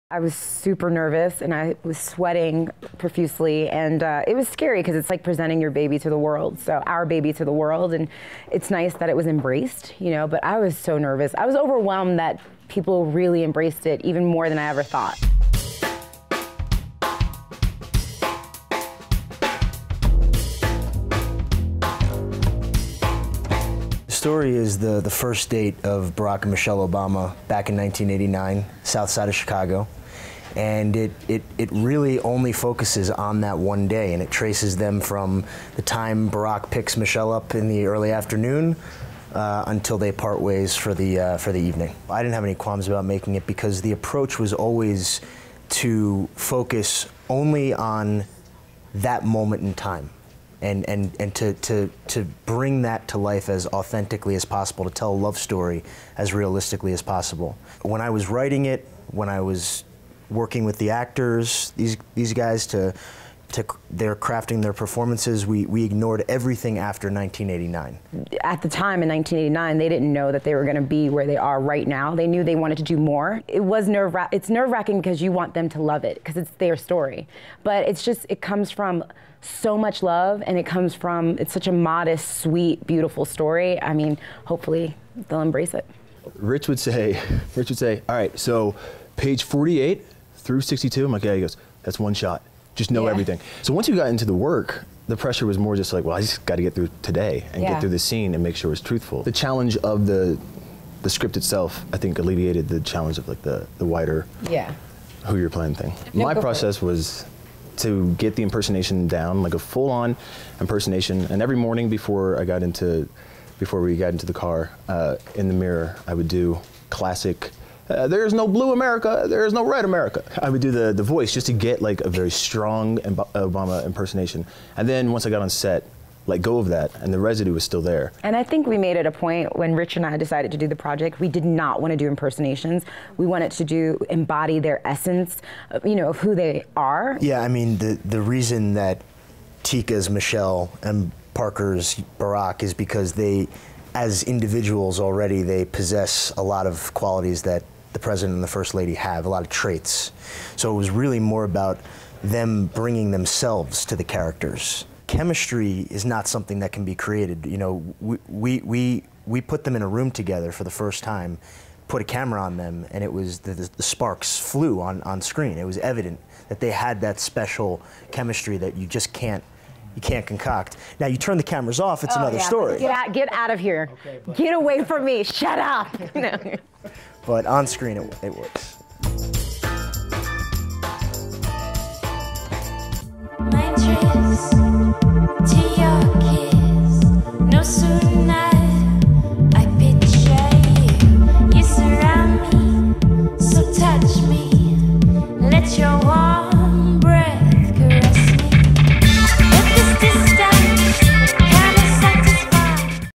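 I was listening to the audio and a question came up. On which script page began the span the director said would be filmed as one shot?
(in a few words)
48.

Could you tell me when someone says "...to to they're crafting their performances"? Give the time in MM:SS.
01:02.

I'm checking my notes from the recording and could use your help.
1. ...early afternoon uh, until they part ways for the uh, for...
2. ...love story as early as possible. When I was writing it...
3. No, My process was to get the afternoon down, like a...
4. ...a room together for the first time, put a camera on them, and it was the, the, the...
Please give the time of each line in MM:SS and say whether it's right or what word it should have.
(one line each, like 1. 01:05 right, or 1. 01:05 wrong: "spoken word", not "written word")
1. 00:37 right
2. 00:55 wrong: "realistically", not "early"
3. 01:46 wrong: "impersonation", not "afternoon"
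4. 02:39 right.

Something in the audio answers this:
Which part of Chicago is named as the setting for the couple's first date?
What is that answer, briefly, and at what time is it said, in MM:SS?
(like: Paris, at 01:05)
South side, at 00:28.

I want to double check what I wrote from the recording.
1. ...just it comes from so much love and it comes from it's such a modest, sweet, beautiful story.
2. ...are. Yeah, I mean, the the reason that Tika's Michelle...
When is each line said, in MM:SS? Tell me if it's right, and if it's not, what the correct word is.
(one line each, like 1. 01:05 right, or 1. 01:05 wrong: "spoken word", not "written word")
1. 01:18 right
2. 02:16 right.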